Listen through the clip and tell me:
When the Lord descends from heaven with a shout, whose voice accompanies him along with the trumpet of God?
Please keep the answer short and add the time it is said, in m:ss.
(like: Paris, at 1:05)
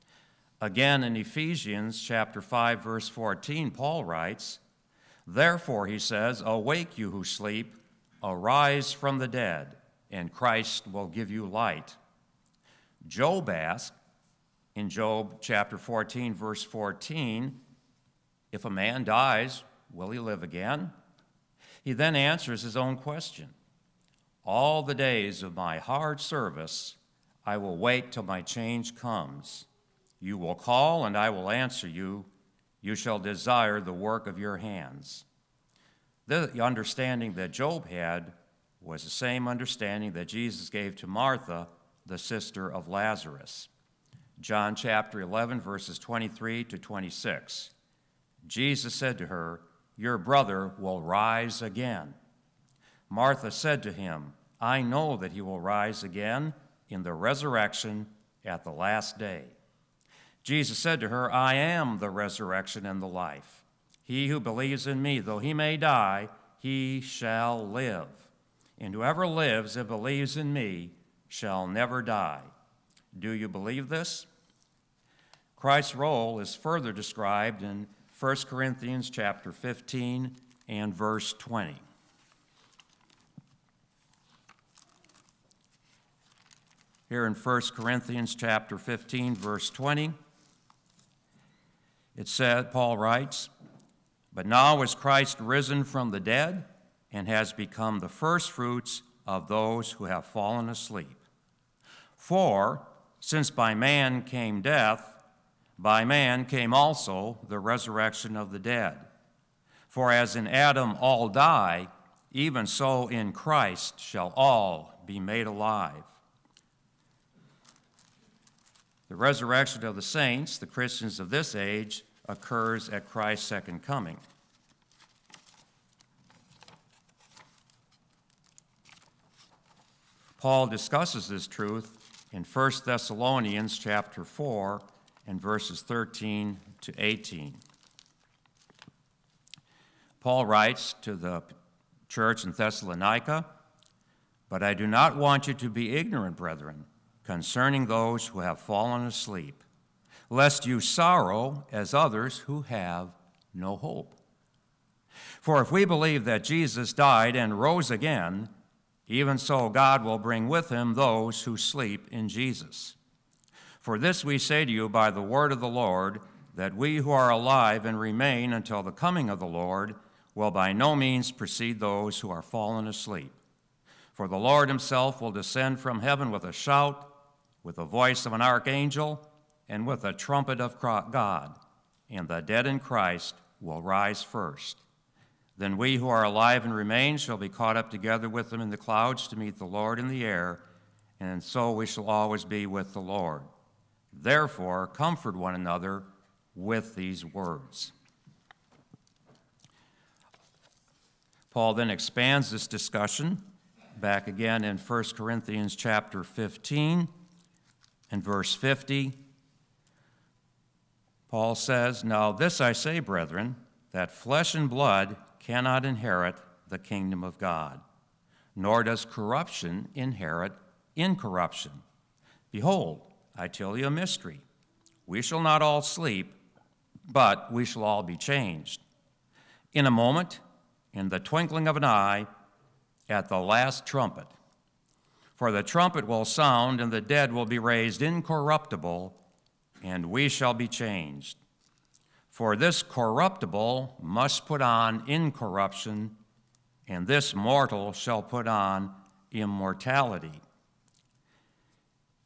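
an archangel, at 2:58.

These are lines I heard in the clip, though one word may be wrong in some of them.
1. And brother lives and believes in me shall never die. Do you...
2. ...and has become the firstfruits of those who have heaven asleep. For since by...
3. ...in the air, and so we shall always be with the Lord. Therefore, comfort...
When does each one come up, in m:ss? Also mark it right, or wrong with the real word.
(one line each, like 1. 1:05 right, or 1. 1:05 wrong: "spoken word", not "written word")
1. 1:08 wrong: "whoever", not "brother"
2. 1:37 wrong: "fallen", not "heaven"
3. 3:09 right.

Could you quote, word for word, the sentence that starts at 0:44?
John chapter 11, verses 23 to 26.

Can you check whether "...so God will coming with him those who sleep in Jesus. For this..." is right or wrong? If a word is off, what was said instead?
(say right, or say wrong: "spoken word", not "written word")
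wrong: "bring", not "coming".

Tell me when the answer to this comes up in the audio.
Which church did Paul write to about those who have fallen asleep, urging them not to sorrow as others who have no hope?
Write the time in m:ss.
2:22.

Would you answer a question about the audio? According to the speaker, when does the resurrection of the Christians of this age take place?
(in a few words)
Christ's second coming.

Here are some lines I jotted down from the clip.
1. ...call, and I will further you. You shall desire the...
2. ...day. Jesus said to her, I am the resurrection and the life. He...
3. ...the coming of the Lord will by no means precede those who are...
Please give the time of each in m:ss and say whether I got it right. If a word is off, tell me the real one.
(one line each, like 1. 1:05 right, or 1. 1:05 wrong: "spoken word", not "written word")
1. 0:30 wrong: "answer", not "further"
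2. 0:59 right
3. 2:48 right.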